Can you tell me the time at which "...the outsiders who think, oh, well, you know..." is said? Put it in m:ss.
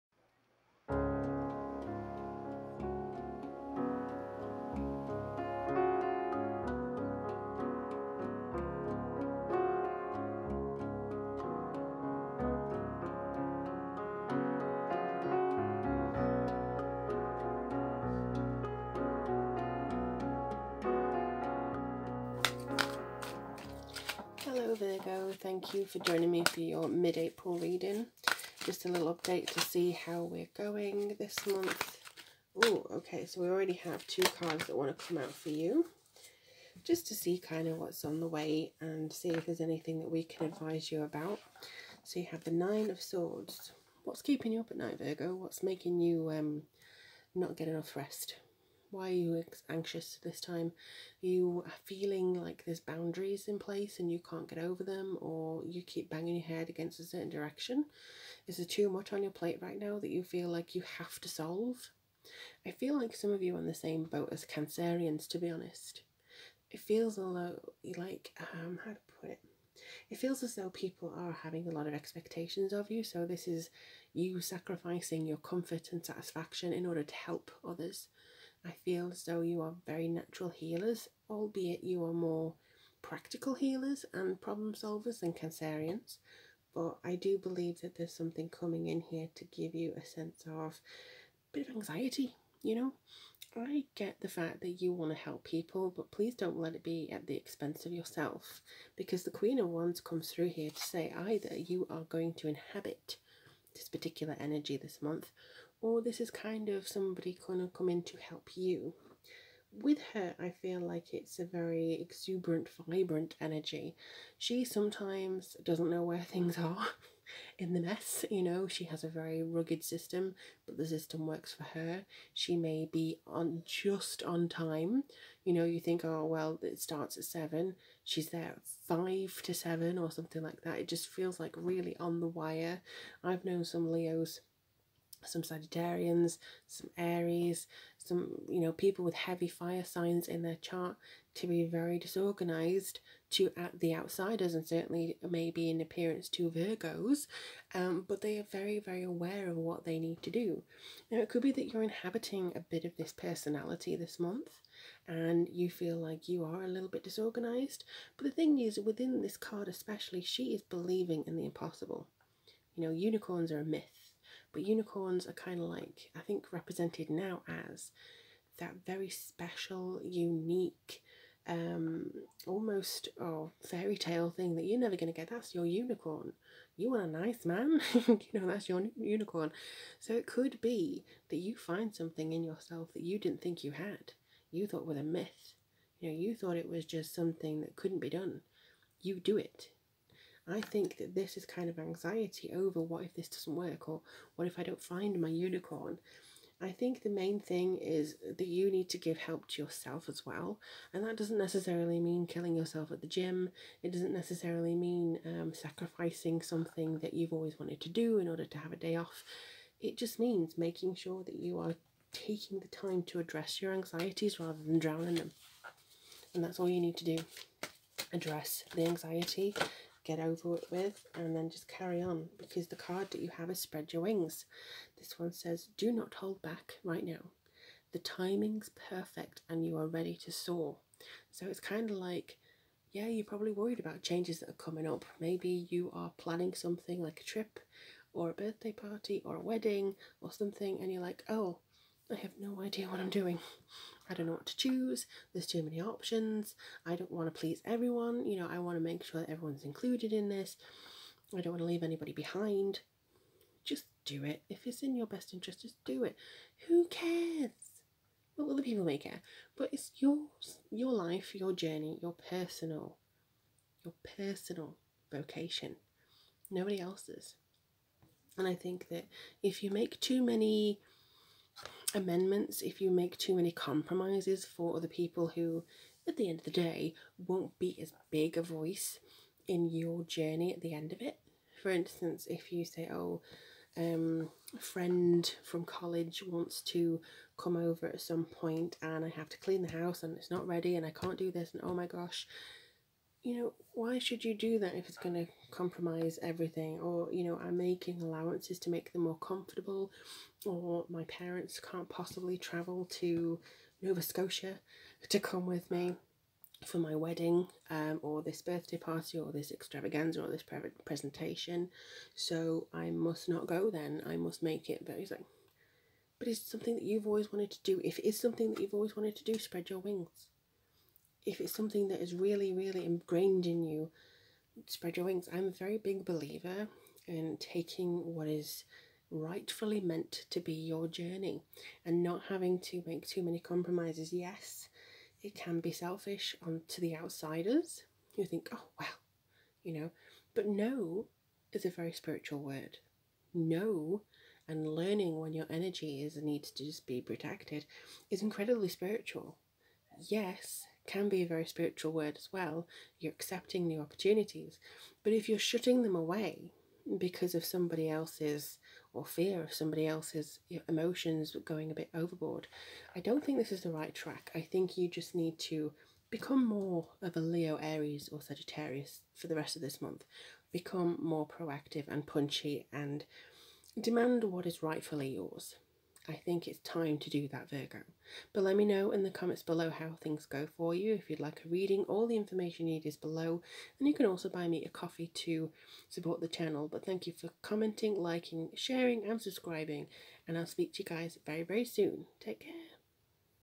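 5:36.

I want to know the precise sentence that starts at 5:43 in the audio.
No and learning when your energy is needs to just be protected is incredibly spiritual.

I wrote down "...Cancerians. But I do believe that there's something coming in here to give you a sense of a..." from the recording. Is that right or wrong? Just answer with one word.
right.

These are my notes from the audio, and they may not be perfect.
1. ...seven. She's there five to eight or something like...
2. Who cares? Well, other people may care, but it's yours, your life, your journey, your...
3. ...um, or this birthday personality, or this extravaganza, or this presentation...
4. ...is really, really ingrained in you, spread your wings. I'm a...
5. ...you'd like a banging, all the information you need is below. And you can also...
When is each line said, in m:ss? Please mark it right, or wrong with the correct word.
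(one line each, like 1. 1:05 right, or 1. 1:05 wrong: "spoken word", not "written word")
1. 2:07 wrong: "seven", not "eight"
2. 4:16 right
3. 5:07 wrong: "party", not "personality"
4. 5:22 right
5. 6:21 wrong: "reading", not "banging".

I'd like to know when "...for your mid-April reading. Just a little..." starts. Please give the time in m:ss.
0:26.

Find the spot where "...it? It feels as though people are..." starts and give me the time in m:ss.
1:09.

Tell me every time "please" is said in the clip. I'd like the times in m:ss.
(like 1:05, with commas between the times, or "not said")
1:36, 4:07.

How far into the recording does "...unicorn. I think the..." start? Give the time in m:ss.
3:15.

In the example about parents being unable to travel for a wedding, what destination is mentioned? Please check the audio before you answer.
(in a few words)
Nova Scotia.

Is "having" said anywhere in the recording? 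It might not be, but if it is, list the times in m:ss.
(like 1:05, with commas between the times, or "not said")
1:11, 5:32.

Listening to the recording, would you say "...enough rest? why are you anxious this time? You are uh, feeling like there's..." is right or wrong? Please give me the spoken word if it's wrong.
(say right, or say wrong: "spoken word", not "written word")
right.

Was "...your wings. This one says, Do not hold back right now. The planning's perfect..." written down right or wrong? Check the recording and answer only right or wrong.
wrong.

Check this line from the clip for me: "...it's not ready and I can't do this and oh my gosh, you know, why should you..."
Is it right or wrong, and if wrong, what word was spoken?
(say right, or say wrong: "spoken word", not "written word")
right.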